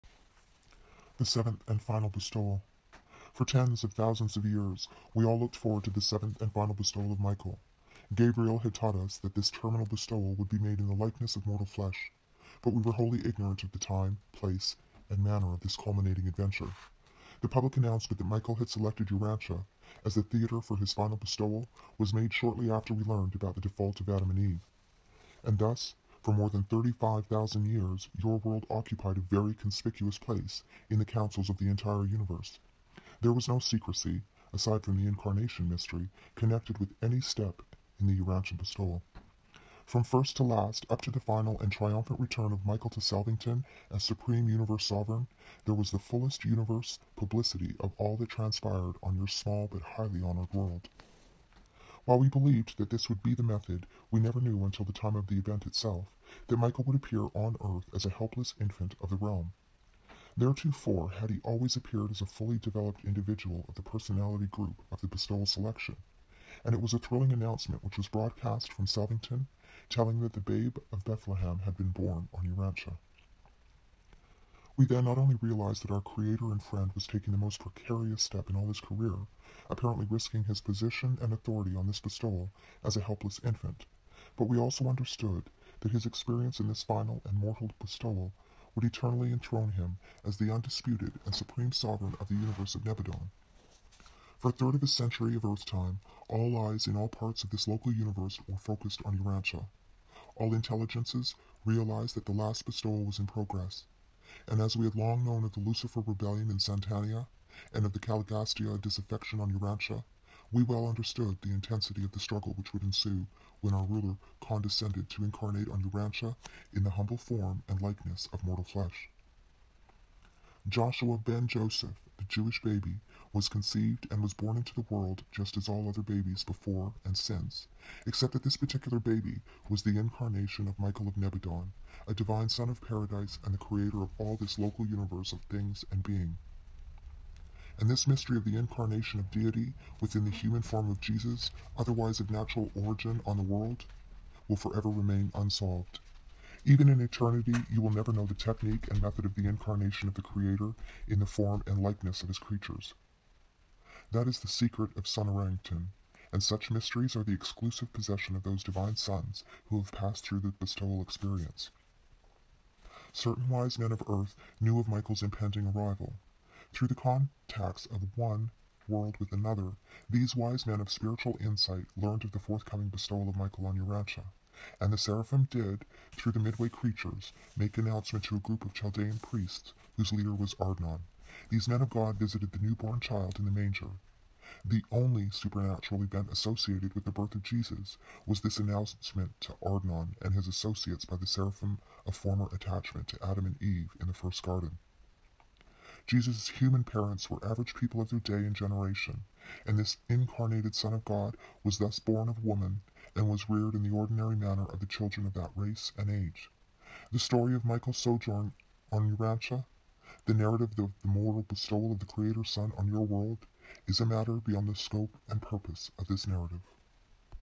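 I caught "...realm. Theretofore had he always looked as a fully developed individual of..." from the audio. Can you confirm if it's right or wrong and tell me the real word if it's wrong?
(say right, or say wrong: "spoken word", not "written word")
wrong: "appeared", not "looked".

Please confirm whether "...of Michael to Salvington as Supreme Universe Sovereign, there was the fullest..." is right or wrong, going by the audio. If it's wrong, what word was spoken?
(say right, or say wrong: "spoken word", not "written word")
right.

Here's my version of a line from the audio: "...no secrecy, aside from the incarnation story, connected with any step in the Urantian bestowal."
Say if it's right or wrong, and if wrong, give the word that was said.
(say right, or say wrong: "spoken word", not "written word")
wrong: "mystery", not "story".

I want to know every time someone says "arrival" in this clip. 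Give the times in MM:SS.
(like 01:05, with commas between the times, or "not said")
02:45.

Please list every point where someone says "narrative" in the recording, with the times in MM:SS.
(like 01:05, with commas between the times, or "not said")
03:30, 03:36.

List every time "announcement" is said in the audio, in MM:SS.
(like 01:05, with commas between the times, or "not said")
00:17, 01:07, 02:57, 03:08.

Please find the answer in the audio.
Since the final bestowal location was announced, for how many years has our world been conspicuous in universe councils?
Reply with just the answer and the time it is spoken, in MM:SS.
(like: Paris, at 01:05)
35,000 years, at 00:26.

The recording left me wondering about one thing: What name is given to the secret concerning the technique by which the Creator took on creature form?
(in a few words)
Sonarington.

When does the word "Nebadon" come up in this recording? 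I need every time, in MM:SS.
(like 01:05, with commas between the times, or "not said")
01:32, 02:11.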